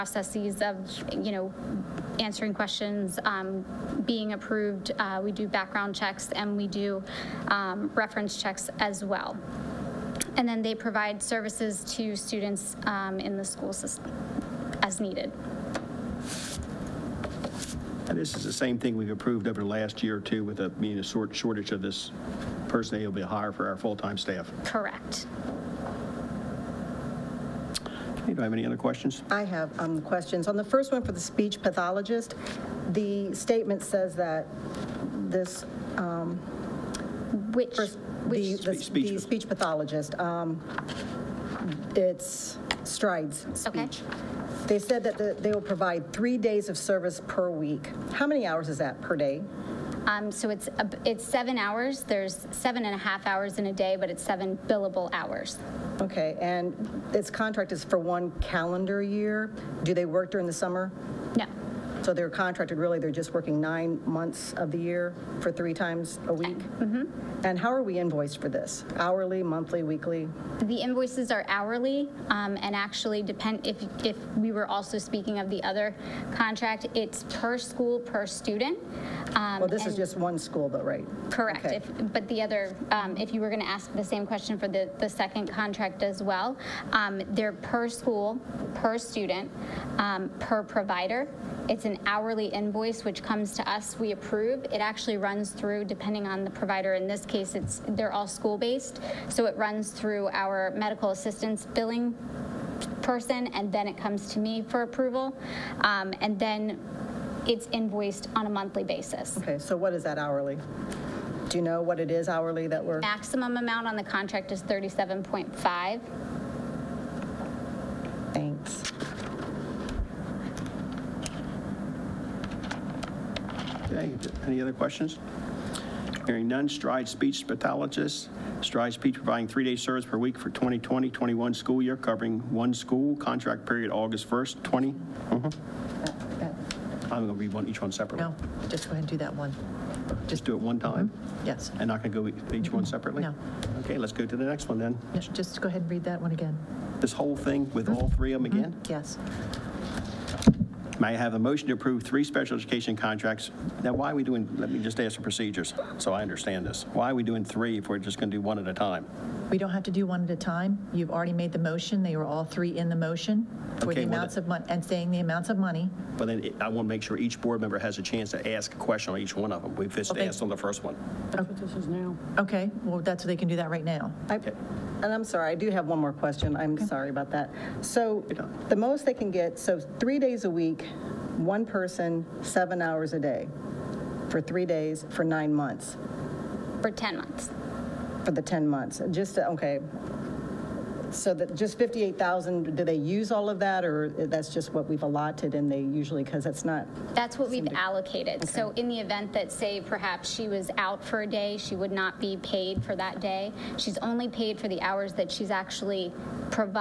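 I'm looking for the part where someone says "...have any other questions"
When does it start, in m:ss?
0:28.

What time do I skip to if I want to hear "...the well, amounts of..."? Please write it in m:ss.
2:44.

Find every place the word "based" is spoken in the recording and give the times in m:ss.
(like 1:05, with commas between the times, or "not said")
1:38.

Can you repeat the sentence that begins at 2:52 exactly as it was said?
Okay, well, that's, they can do that right now.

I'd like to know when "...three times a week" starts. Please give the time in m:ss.
1:05.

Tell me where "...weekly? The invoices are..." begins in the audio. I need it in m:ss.
1:09.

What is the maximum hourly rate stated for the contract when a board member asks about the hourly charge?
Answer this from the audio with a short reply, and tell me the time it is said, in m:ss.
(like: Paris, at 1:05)
37.5, at 1:54.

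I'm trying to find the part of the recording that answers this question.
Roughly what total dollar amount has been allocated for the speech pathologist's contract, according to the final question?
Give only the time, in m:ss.
3:11.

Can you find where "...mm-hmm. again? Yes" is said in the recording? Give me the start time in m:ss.
2:28.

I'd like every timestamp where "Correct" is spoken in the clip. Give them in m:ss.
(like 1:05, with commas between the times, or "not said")
0:24, 1:21.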